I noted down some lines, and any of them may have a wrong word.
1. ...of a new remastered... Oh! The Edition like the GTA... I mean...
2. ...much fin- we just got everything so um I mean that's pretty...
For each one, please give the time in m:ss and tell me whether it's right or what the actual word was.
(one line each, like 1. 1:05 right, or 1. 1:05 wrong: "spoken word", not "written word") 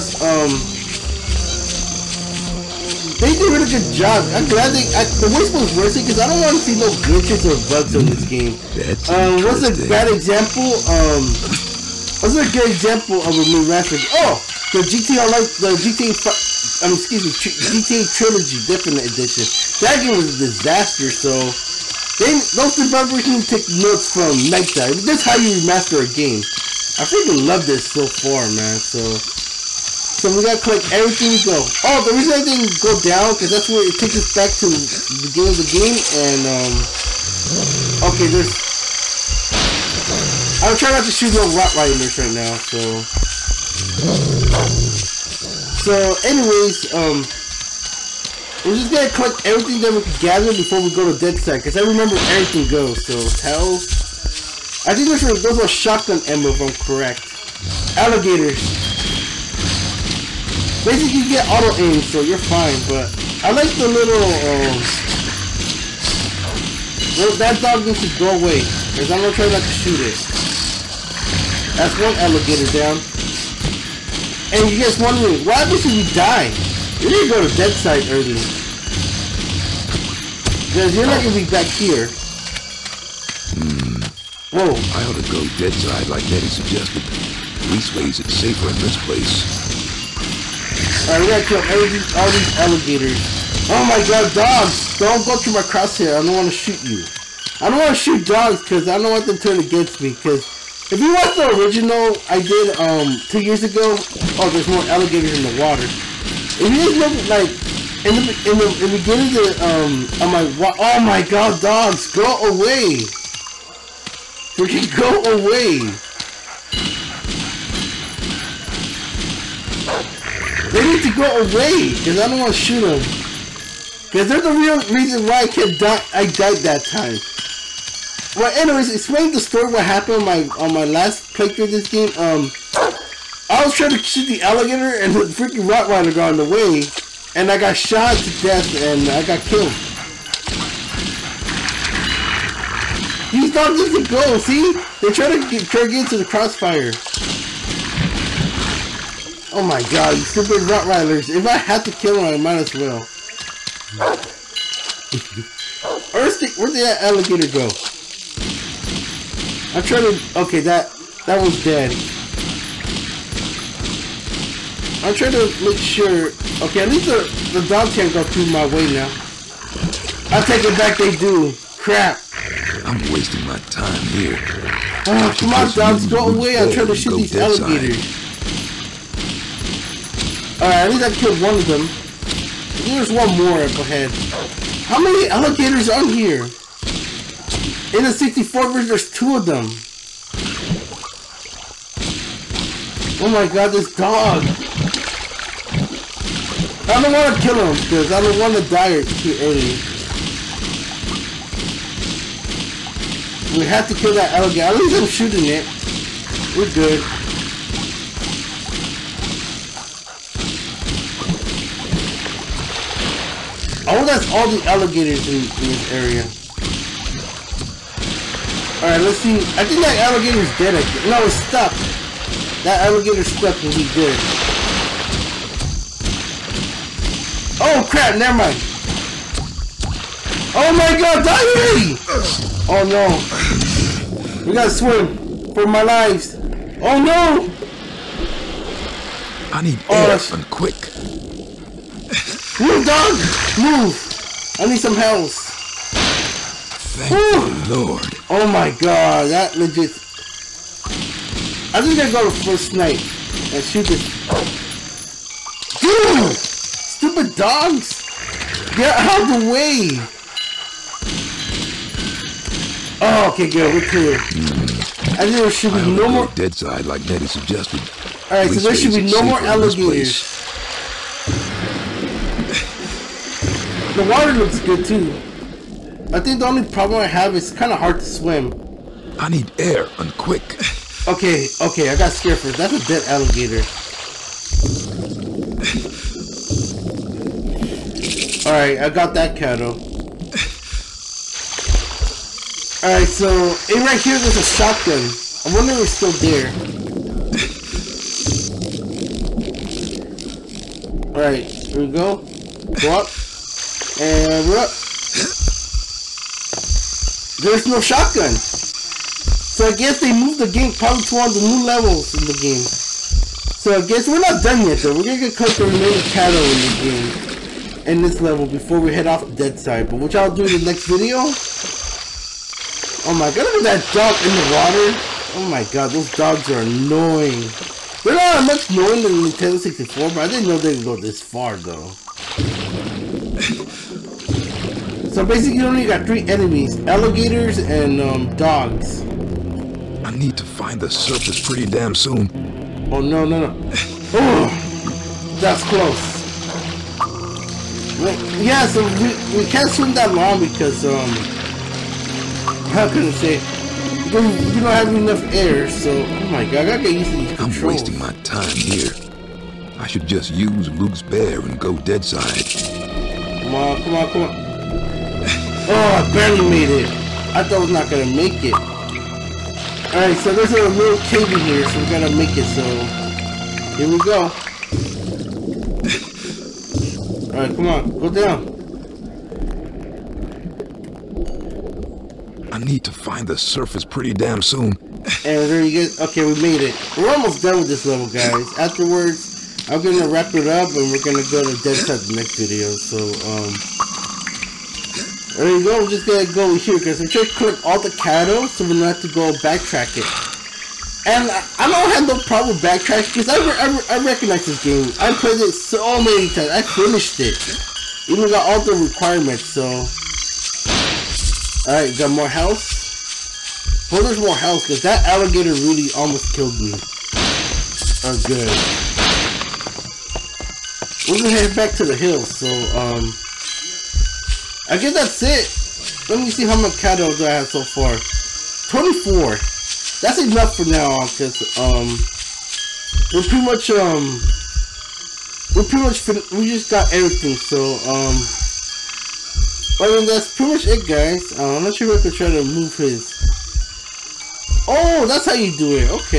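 1. 0:13 wrong: "GTA", not "Edition"
2. 7:15 right.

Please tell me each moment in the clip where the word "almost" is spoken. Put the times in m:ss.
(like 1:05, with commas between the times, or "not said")
6:27, 6:55.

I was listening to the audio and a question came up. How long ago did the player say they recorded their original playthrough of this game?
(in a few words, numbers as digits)
2 years.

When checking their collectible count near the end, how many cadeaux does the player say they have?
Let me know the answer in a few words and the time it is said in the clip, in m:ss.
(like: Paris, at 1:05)
24, at 7:08.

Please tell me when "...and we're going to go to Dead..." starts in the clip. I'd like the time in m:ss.
6:30.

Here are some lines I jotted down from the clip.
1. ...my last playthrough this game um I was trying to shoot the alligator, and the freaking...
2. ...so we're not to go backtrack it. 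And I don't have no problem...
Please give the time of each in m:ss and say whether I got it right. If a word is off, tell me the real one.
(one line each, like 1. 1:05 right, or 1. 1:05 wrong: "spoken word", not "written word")
1. 2:10 right
2. 6:38 right.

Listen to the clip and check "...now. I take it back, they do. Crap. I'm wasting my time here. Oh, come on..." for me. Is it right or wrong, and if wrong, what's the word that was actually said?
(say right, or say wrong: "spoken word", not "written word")
right.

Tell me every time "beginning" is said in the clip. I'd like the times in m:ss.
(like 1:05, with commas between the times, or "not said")
0:35, 1:48.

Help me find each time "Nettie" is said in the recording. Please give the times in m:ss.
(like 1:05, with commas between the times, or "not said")
1:26, 4:27.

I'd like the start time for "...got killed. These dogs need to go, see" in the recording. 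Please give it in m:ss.
2:19.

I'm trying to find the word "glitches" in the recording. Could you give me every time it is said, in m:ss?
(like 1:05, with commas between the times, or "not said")
0:07.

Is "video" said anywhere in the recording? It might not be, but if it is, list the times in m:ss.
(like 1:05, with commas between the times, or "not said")
5:20, 6:32.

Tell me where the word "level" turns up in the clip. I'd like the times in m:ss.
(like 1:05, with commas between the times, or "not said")
5:11, 5:18, 6:27.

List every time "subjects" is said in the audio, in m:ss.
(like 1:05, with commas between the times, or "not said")
not said.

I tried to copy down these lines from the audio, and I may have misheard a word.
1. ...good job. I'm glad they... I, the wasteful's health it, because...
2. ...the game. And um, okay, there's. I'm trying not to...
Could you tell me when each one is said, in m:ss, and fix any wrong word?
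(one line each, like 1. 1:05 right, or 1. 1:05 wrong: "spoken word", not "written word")
1. 0:03 wrong: "worth", not "health"
2. 0:35 right.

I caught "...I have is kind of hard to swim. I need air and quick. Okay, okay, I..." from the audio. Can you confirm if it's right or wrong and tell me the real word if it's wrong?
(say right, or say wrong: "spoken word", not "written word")
right.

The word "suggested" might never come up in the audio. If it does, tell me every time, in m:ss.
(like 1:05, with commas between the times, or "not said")
1:26, 4:27.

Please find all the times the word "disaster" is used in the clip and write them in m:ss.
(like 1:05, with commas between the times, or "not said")
0:20.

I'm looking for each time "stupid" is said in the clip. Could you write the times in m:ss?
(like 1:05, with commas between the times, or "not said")
2:30, 4:17.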